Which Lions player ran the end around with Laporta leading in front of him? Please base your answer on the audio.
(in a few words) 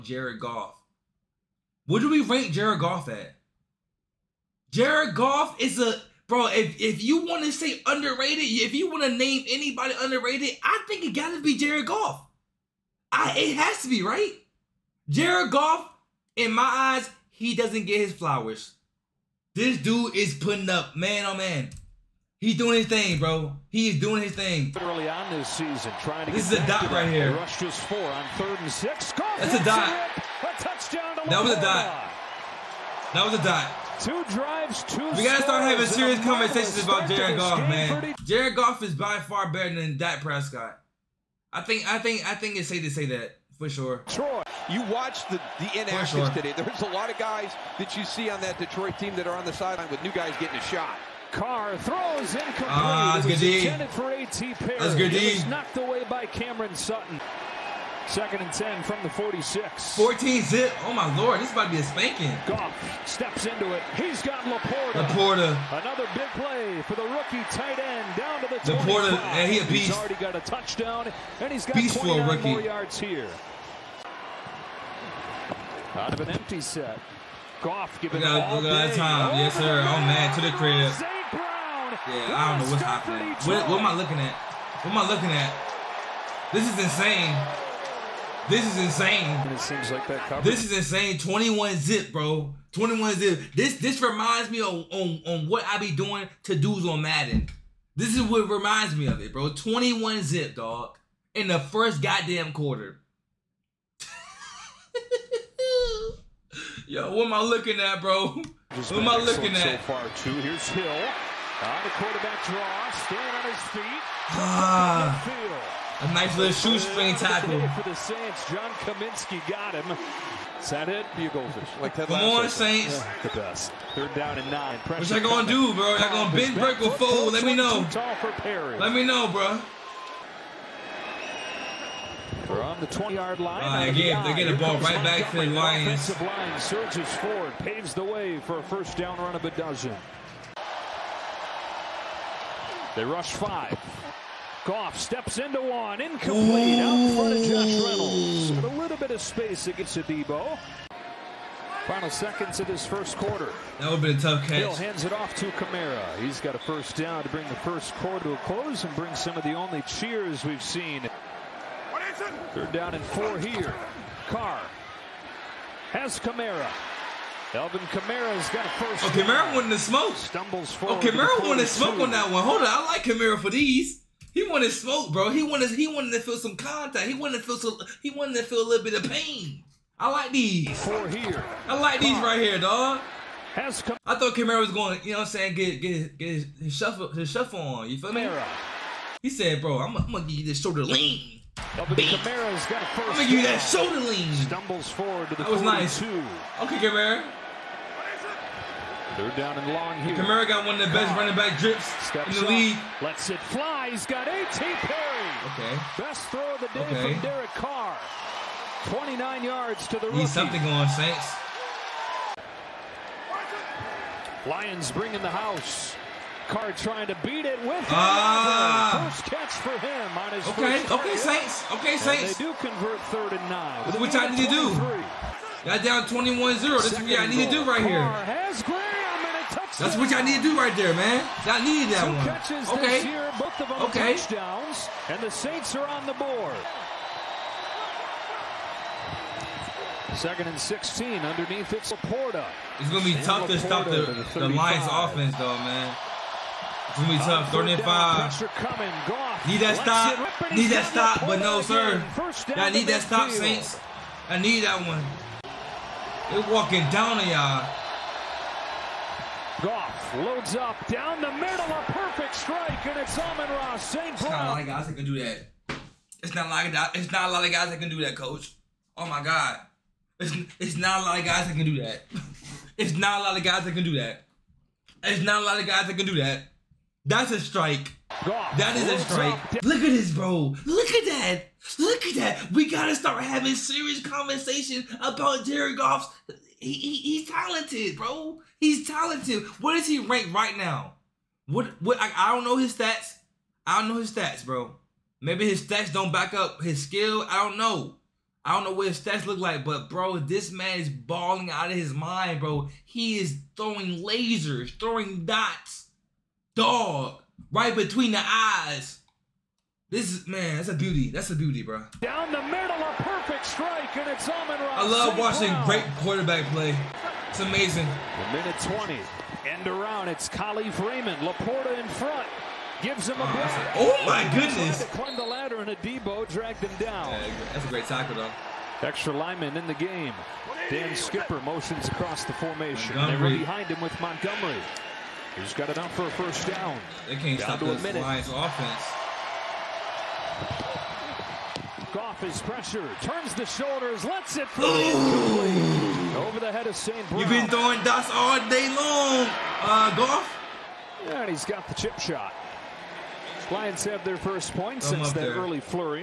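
Kalif Raymond.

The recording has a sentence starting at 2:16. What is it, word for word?
The line surges forward, paves the way for a first down run of a dozen.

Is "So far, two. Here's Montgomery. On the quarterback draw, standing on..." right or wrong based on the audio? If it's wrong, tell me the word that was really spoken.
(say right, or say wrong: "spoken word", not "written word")
wrong: "Hill", not "Montgomery".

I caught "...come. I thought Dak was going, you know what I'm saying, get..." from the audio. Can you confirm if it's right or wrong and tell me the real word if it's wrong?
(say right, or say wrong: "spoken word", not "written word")
wrong: "Camaro", not "Dak".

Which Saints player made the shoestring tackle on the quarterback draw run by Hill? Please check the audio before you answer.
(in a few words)
John Kaminsky.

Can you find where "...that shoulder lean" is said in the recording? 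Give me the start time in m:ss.
3:13.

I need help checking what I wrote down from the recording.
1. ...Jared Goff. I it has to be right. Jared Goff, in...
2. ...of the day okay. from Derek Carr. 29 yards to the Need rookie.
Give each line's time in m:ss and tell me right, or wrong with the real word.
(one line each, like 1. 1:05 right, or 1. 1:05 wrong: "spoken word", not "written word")
1. 0:11 right
2. 3:26 right.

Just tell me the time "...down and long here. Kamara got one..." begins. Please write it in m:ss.
3:19.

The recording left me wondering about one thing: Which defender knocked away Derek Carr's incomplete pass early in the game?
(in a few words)
Cameron Sutton.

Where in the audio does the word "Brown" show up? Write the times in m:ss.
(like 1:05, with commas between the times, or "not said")
4:24, 5:15, 5:47.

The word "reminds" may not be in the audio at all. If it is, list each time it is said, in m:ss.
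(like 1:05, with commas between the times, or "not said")
1:34, 1:38.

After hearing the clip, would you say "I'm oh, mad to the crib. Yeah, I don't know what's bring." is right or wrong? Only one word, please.
wrong.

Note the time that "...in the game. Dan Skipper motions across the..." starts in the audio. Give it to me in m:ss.
5:29.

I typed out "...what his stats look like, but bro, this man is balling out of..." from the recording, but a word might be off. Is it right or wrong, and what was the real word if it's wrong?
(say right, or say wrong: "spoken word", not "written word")
right.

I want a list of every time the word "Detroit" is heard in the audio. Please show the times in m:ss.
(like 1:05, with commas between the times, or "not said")
0:48.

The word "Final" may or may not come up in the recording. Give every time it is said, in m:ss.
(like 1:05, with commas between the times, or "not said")
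2:31.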